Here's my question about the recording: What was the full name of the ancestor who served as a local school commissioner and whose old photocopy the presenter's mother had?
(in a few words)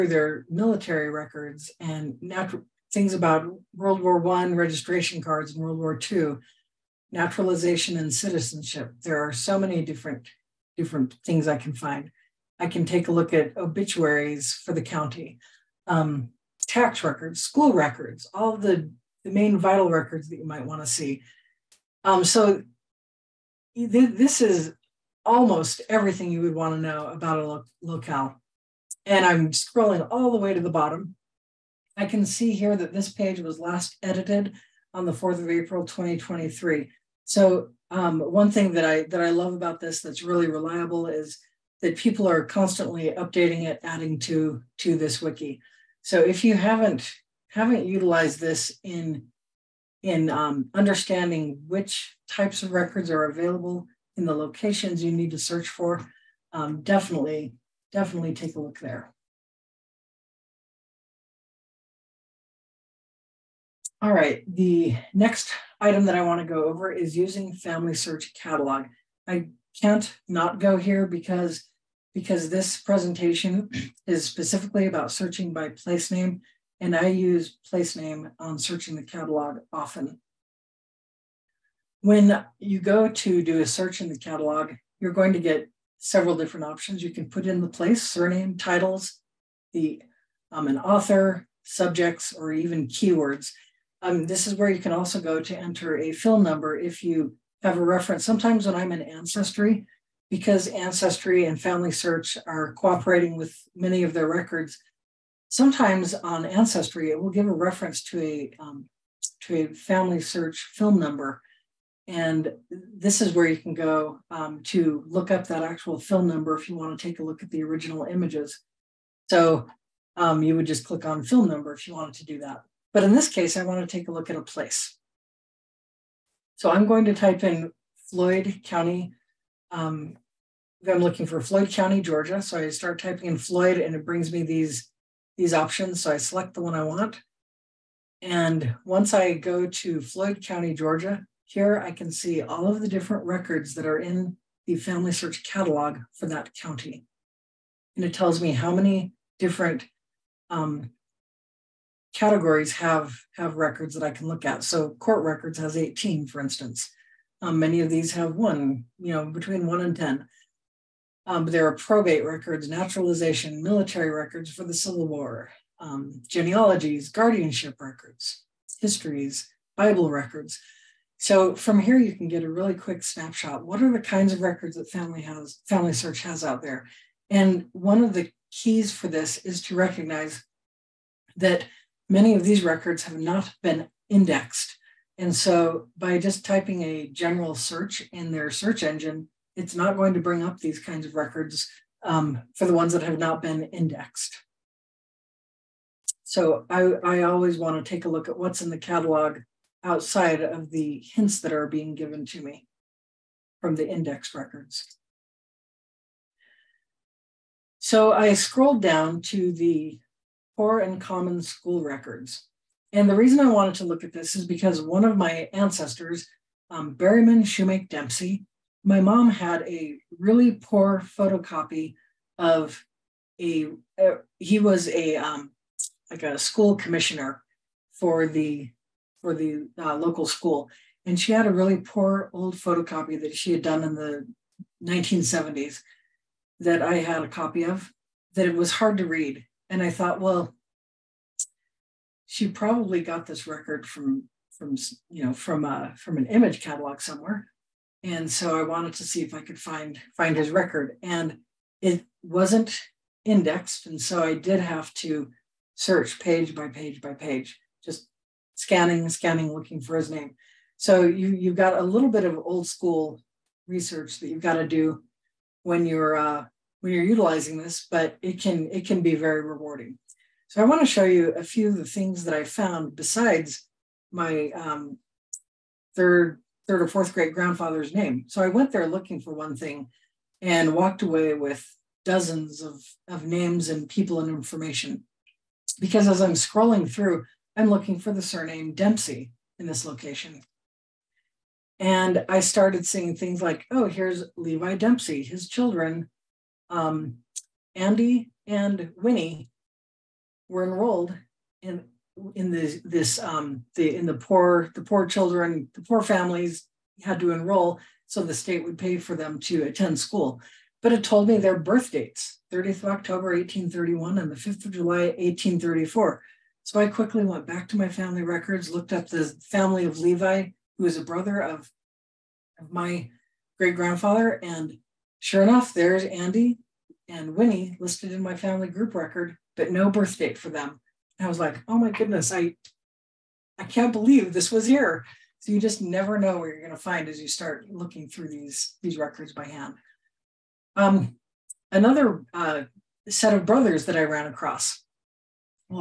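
Berryman Shoemake Dempsey.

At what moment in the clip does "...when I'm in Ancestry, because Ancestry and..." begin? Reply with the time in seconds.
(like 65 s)
98 s.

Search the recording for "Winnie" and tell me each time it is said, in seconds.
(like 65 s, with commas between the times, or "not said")
298 s, 327 s.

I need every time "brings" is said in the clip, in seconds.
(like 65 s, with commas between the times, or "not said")
134 s, 190 s.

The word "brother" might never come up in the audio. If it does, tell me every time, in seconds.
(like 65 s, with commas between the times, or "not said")
321 s, 343 s.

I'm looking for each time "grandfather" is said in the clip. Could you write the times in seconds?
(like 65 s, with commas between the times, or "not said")
277 s, 323 s.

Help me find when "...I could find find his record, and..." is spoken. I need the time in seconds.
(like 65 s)
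249 s.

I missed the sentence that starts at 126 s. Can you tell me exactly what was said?
So I'm going to type in Floyd County.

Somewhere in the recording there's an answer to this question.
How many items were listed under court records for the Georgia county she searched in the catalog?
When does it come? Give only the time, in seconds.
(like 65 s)
155 s.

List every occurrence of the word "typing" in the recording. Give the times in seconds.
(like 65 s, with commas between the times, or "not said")
133 s, 186 s.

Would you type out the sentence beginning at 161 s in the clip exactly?
Um, there are probate records, naturalization, military records for the Civil War, um, genealogies, guardianship records, histories, Bible records.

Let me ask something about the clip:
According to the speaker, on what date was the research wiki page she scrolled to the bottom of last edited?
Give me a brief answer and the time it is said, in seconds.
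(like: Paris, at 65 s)
4 April 2023, at 35 s.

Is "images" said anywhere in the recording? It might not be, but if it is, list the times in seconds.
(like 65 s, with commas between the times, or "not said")
118 s, 246 s.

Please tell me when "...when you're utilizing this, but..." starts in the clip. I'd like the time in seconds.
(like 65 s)
266 s.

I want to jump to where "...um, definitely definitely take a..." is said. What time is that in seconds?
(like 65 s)
56 s.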